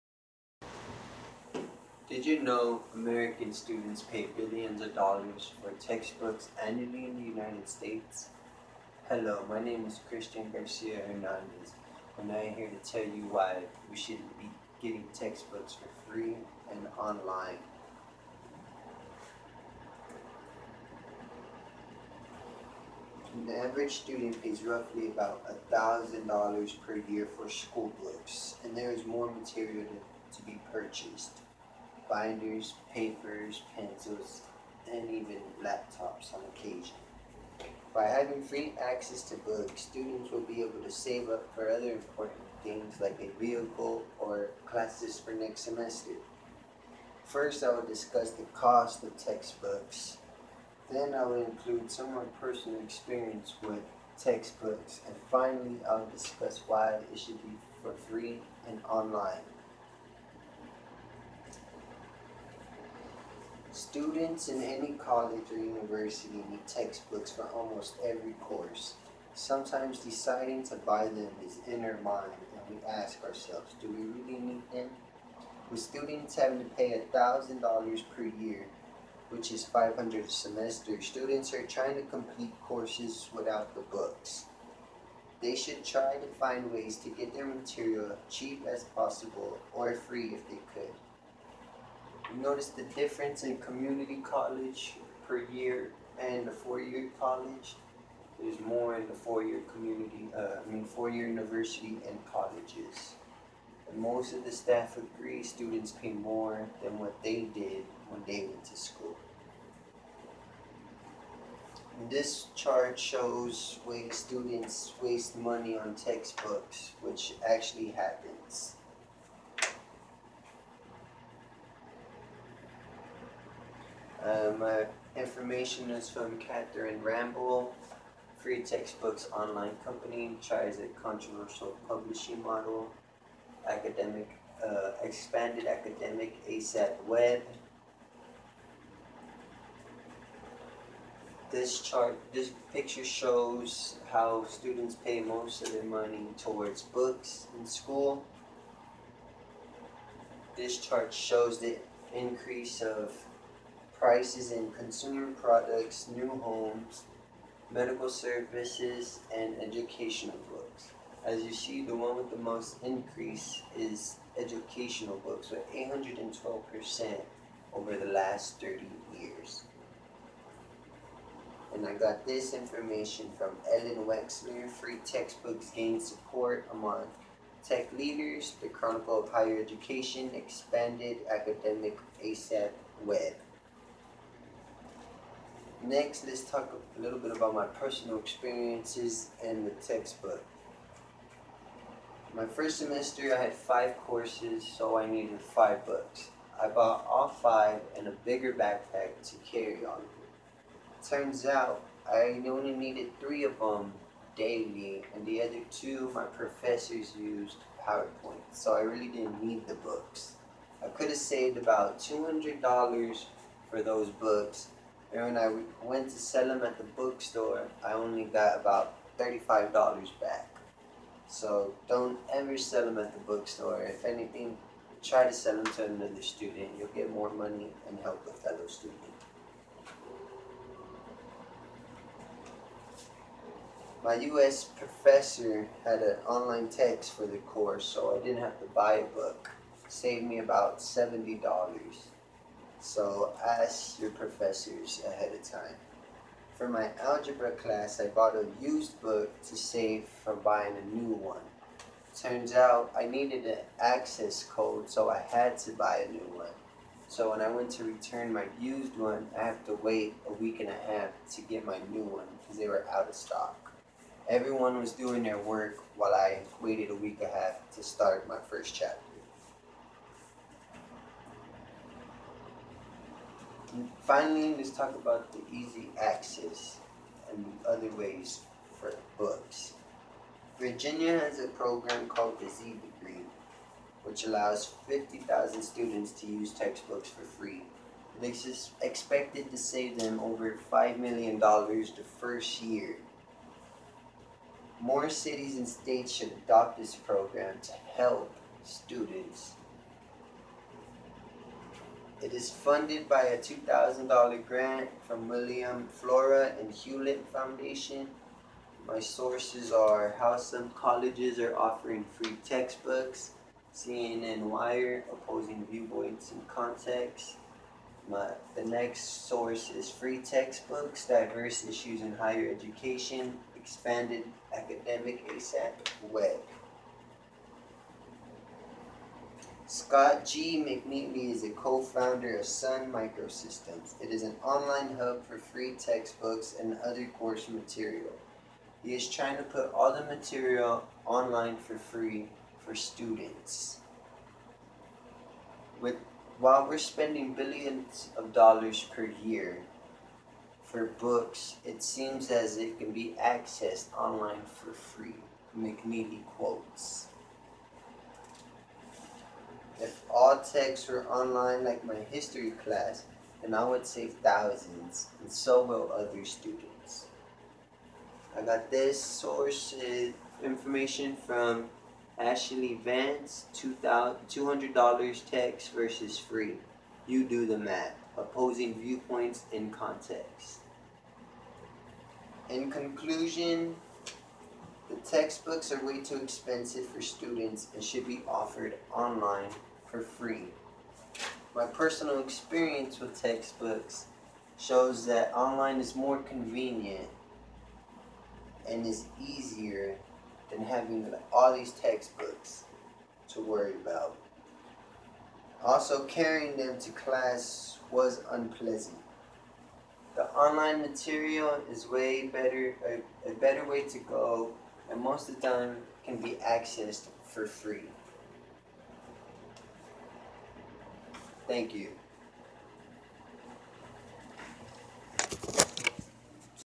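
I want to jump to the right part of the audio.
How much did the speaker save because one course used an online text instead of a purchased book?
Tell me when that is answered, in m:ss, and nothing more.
4:00.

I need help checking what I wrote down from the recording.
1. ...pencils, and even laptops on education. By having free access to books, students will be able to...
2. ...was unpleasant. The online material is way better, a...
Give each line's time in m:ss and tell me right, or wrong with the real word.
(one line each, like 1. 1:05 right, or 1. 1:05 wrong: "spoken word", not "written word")
1. 0:33 wrong: "occasion", not "education"
2. 6:47 right.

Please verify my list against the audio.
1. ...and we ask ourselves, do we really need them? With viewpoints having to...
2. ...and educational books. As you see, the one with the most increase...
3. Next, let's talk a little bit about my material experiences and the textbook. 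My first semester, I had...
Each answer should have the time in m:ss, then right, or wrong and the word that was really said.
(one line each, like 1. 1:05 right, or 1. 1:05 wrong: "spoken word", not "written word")
1. 1:12 wrong: "students", not "viewpoints"
2. 2:39 right
3. 3:05 wrong: "personal", not "material".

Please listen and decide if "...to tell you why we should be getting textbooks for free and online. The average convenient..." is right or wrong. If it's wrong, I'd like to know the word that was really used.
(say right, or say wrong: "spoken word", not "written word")
wrong: "student", not "convenient".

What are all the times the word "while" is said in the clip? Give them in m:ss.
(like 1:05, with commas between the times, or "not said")
4:25, 5:46.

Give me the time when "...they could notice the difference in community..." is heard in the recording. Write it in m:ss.
1:30.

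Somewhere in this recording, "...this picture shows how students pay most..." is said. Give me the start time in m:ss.
2:22.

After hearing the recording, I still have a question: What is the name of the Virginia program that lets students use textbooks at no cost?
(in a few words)
Z Degree.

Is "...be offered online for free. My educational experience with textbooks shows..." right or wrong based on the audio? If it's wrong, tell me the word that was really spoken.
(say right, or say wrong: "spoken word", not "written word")
wrong: "personal", not "educational".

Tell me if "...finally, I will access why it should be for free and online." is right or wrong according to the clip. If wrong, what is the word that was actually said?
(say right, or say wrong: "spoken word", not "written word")
wrong: "discuss", not "access".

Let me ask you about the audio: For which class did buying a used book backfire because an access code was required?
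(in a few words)
algebra.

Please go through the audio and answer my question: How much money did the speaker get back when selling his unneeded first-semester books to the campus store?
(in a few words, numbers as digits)
$35.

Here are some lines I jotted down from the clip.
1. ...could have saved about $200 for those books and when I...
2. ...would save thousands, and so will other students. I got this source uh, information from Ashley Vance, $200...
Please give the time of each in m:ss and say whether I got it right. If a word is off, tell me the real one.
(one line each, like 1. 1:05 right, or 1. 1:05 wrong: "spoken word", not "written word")
1. 3:30 right
2. 6:03 right.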